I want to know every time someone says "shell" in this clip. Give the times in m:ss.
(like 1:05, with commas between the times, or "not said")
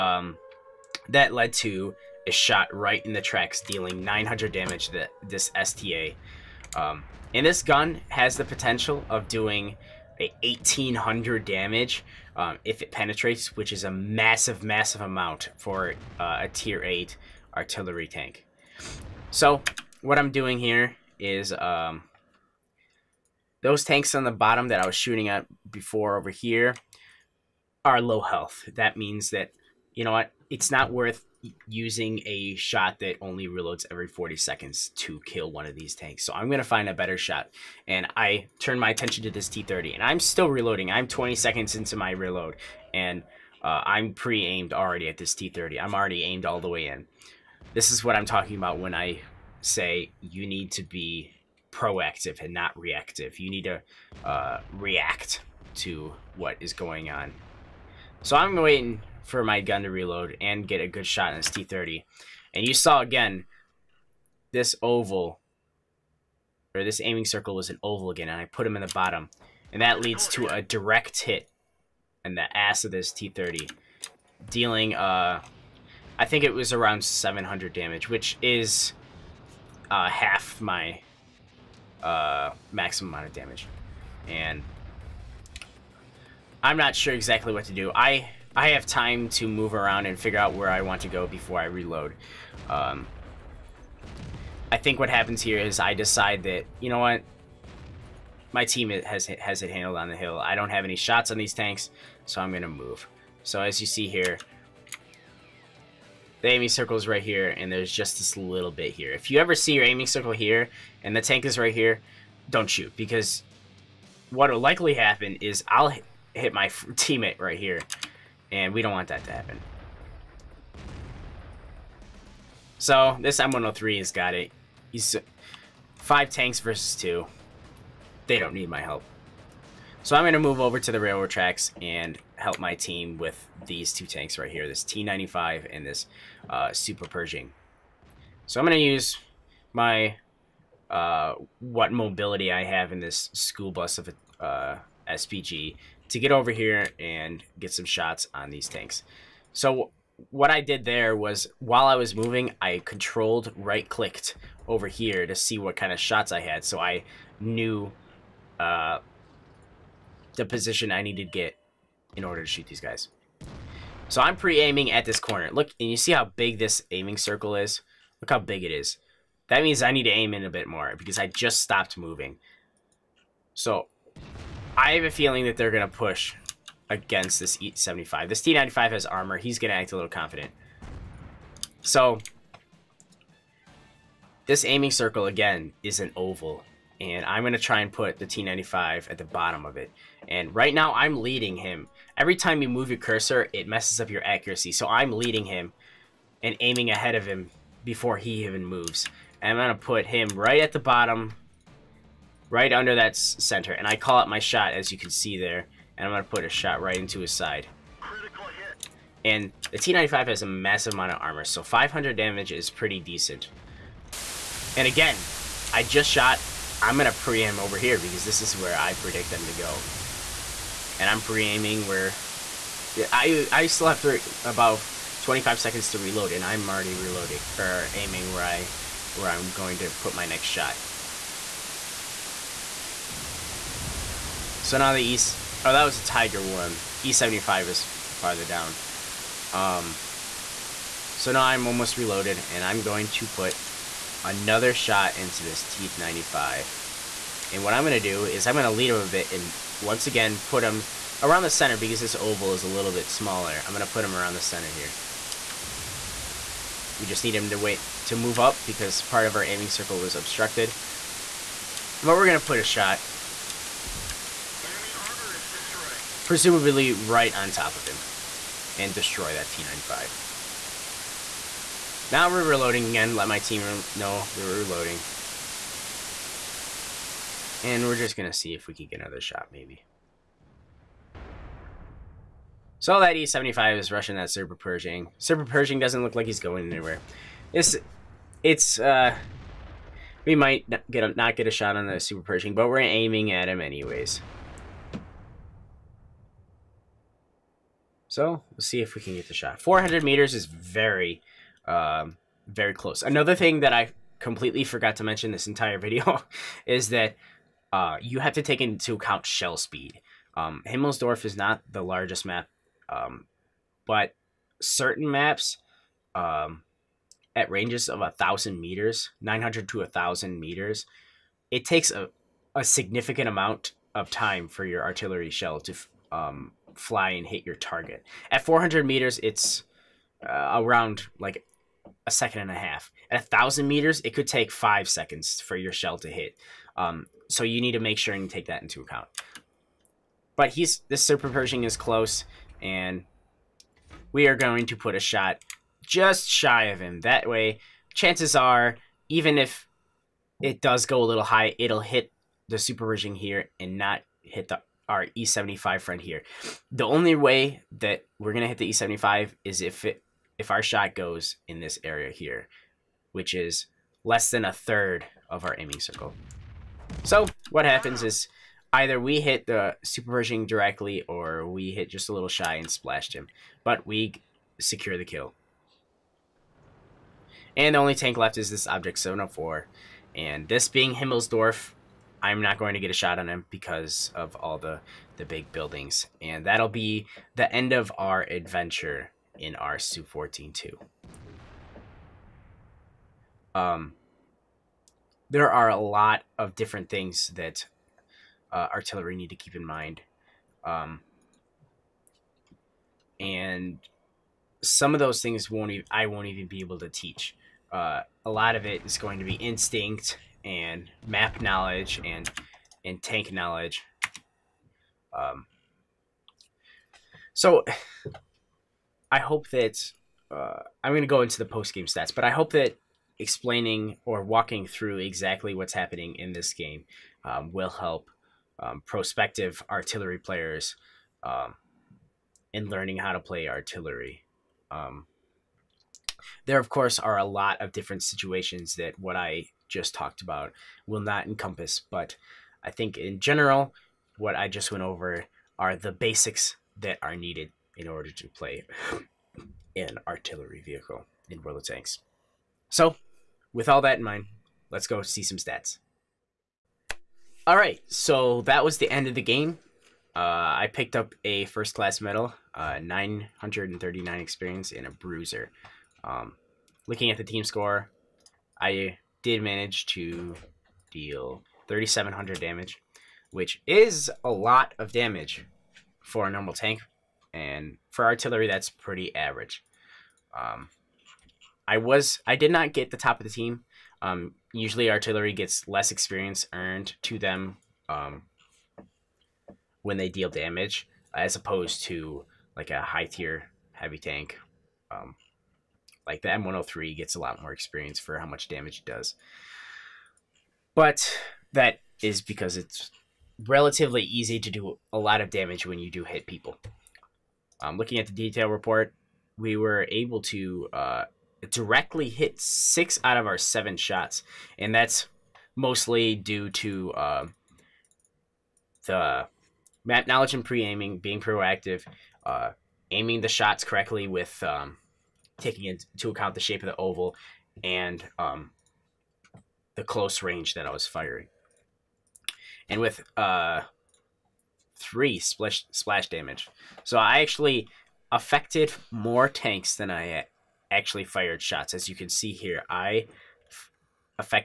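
5:09, 5:25, 5:35.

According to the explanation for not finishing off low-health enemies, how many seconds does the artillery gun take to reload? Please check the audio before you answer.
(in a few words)
40 seconds.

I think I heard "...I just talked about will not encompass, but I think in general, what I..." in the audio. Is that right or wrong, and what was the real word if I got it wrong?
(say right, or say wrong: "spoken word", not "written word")
right.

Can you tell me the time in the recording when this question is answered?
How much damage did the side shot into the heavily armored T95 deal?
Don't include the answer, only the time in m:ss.
3:31.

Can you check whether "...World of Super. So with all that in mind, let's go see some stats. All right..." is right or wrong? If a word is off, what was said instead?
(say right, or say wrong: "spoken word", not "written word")
wrong: "Tanks", not "Super".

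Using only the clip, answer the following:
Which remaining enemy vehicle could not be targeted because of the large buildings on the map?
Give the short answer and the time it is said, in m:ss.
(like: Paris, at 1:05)
Object 704, at 6:18.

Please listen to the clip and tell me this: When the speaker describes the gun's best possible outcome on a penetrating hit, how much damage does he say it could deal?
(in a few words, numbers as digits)
1800.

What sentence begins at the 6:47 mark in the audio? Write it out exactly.
Uh, a lot of it is going to be instinct and map knowledge and and tank knowledge.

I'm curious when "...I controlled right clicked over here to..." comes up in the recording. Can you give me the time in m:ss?
2:32.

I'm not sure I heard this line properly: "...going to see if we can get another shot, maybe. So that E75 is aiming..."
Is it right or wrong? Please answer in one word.
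wrong.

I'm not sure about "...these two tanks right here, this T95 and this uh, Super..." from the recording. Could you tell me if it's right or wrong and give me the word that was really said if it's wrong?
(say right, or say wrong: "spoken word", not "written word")
right.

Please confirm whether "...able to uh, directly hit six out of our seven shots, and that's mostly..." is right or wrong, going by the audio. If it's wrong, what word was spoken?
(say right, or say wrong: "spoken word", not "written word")
right.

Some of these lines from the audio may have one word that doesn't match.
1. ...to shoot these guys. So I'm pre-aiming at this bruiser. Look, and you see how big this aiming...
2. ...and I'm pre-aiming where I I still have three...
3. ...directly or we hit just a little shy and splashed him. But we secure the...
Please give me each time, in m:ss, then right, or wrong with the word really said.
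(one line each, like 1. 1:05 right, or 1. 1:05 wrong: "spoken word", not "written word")
1. 2:42 wrong: "corner", not "bruiser"
2. 3:40 right
3. 6:10 right.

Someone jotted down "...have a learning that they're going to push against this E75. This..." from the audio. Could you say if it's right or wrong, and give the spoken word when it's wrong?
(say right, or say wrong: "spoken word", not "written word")
wrong: "feeling", not "learning".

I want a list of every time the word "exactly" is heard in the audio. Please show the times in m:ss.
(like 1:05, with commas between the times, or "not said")
1:27, 7:04.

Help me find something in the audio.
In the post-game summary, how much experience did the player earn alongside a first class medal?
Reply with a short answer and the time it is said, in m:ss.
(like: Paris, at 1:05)
939, at 7:42.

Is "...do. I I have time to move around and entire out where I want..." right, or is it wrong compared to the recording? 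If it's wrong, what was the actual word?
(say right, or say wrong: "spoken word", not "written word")
wrong: "figure", not "entire".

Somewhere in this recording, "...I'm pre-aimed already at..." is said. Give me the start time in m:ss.
0:43.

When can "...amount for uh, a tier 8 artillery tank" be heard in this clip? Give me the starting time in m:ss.
0:15.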